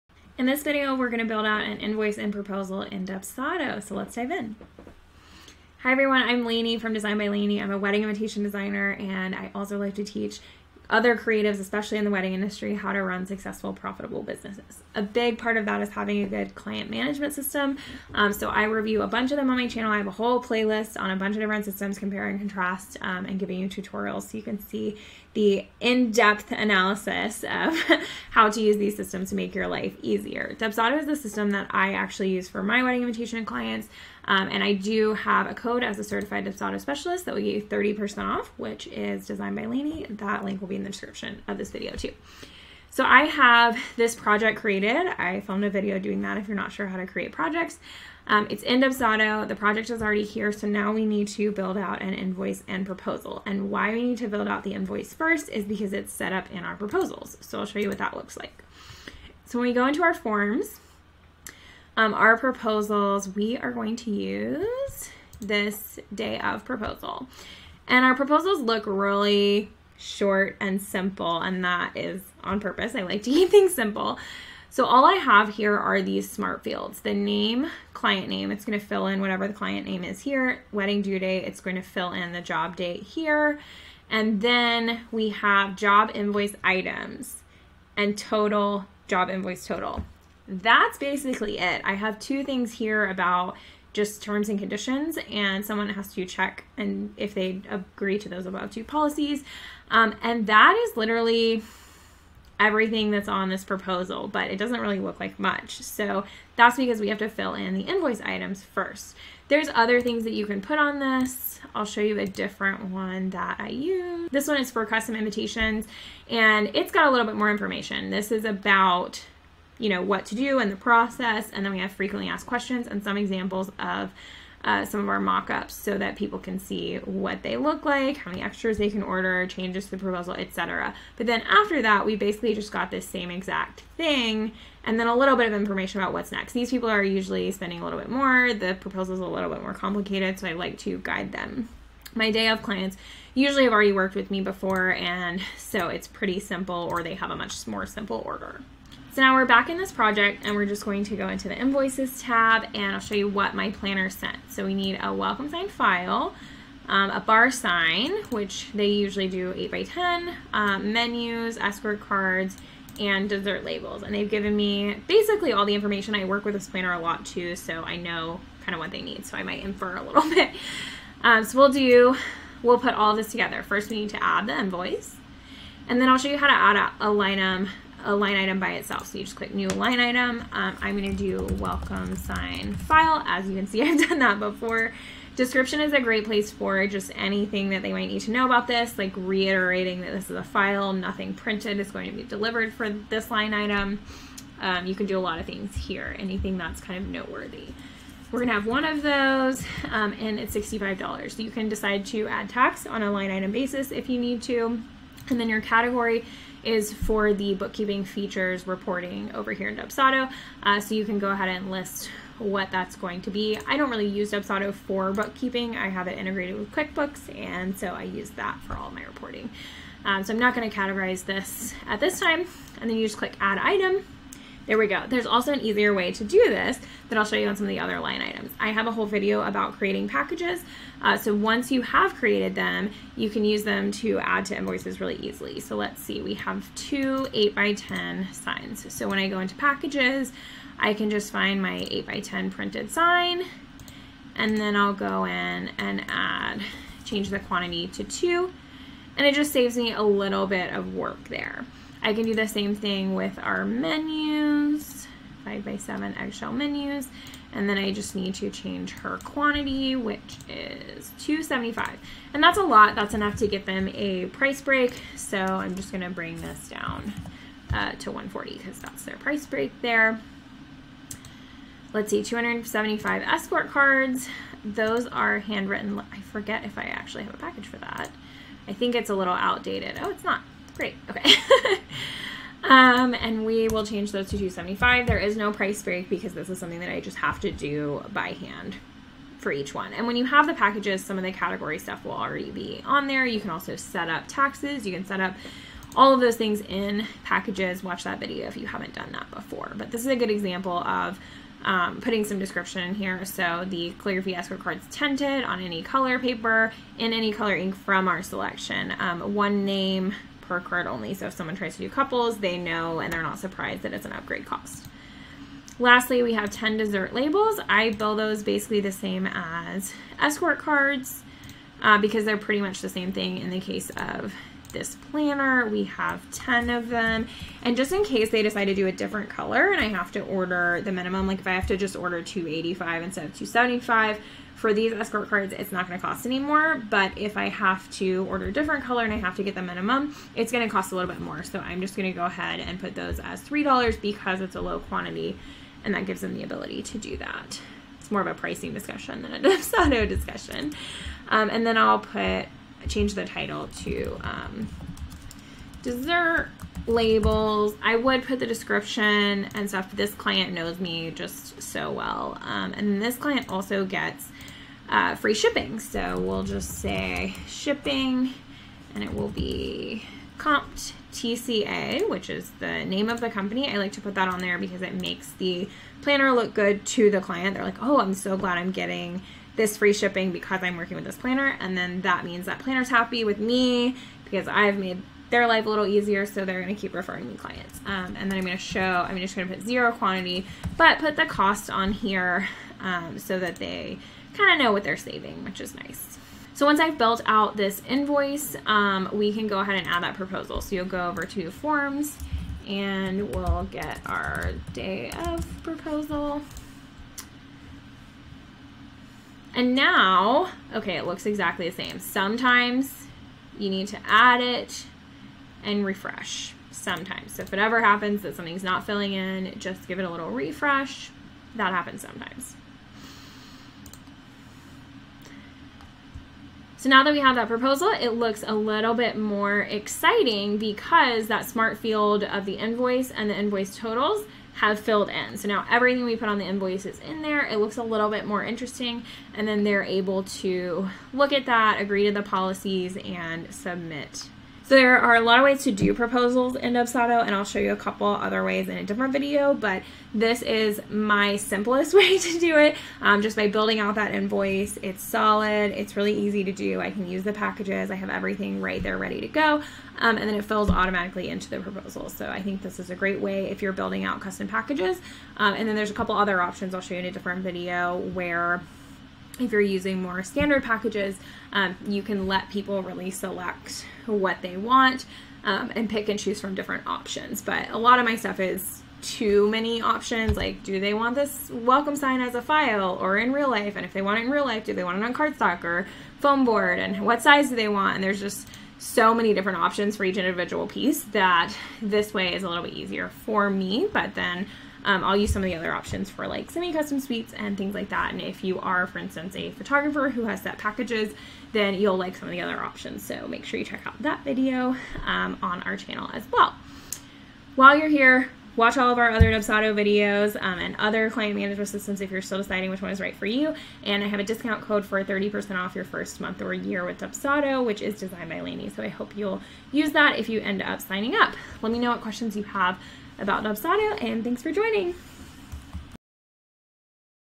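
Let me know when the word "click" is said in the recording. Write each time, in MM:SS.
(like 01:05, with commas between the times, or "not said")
02:59, 03:43.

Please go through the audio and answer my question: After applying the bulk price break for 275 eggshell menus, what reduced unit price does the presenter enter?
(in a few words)
140.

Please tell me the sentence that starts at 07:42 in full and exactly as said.
So I think this is a great way if you're building out custom packages.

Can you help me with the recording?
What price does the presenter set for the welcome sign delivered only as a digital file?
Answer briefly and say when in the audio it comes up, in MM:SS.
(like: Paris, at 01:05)
$65, at 03:20.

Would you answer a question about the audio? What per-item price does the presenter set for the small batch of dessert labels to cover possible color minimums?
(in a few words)
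$3.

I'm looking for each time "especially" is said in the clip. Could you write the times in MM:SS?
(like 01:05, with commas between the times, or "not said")
00:11.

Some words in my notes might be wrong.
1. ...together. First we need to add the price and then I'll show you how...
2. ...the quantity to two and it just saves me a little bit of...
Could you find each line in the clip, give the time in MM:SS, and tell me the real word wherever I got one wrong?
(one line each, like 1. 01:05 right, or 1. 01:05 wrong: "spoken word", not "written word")
1. 02:53 wrong: "invoice", not "price"
2. 04:07 right.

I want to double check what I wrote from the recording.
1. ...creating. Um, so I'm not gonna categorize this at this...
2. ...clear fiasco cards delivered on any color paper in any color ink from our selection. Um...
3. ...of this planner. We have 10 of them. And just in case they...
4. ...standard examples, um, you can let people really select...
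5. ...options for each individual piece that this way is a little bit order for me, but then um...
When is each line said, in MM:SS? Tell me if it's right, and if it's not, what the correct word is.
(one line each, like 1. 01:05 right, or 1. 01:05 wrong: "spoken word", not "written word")
1. 03:39 wrong: "reporting", not "creating"
2. 05:03 wrong: "tinted", not "delivered"
3. 05:23 right
4. 07:50 wrong: "packages", not "examples"
5. 08:09 wrong: "easier", not "order".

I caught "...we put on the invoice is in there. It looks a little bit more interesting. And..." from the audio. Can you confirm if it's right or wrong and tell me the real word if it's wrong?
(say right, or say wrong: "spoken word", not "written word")
right.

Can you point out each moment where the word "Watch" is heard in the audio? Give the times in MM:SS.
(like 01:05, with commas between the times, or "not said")
04:57, 08:28.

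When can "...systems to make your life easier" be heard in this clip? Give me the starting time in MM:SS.
00:28.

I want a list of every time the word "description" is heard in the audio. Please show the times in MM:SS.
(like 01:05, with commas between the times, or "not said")
00:40, 03:05, 05:02, 05:58.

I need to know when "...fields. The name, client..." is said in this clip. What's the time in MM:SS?
01:16.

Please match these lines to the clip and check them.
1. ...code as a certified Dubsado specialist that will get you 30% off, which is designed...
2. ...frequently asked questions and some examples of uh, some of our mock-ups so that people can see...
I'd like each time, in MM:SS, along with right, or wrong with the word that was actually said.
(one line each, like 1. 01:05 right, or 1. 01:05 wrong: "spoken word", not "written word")
1. 00:35 right
2. 02:01 right.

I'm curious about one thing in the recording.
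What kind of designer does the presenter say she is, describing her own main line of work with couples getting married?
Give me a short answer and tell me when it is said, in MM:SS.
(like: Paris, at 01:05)
Wedding invitation designer, at 00:07.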